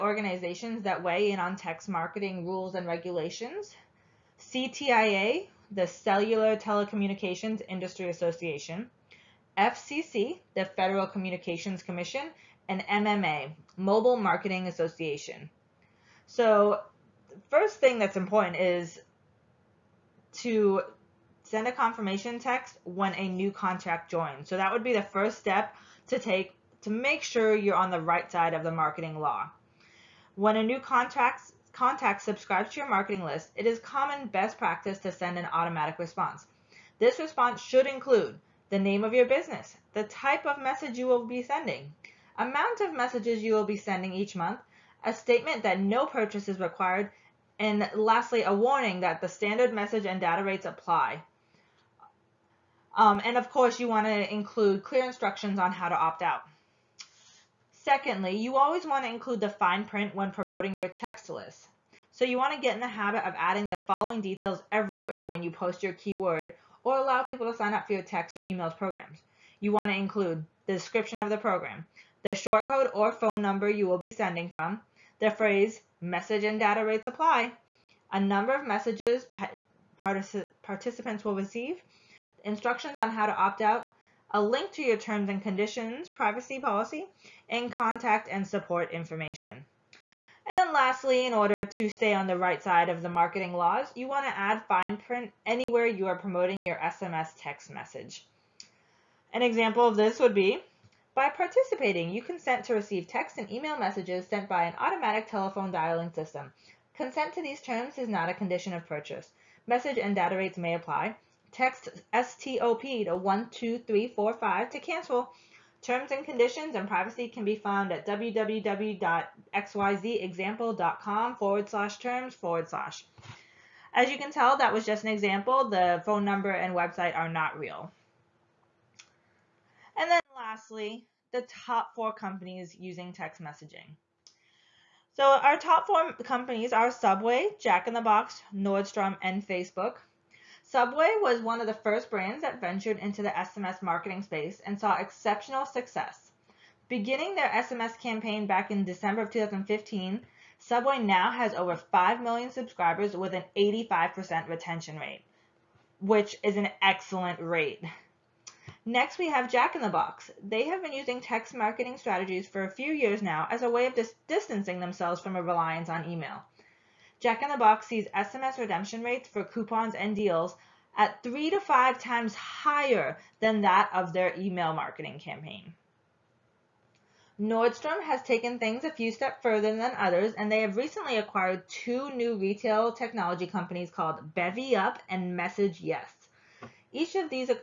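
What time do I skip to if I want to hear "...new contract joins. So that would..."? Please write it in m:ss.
0:23.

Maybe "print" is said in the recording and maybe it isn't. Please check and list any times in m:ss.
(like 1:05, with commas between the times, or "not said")
0:59, 1:34.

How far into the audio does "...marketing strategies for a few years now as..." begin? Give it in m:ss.
2:41.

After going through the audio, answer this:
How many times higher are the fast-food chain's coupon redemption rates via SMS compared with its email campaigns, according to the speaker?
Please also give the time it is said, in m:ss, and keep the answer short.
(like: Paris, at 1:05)
3 to 5 times, at 2:51.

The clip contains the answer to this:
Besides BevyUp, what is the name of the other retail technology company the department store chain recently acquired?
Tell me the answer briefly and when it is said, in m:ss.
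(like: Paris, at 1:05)
MessageYes, at 3:05.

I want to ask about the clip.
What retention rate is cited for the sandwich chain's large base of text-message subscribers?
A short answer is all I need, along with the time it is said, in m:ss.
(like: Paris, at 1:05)
85%, at 2:33.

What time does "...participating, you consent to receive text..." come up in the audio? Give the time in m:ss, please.
1:41.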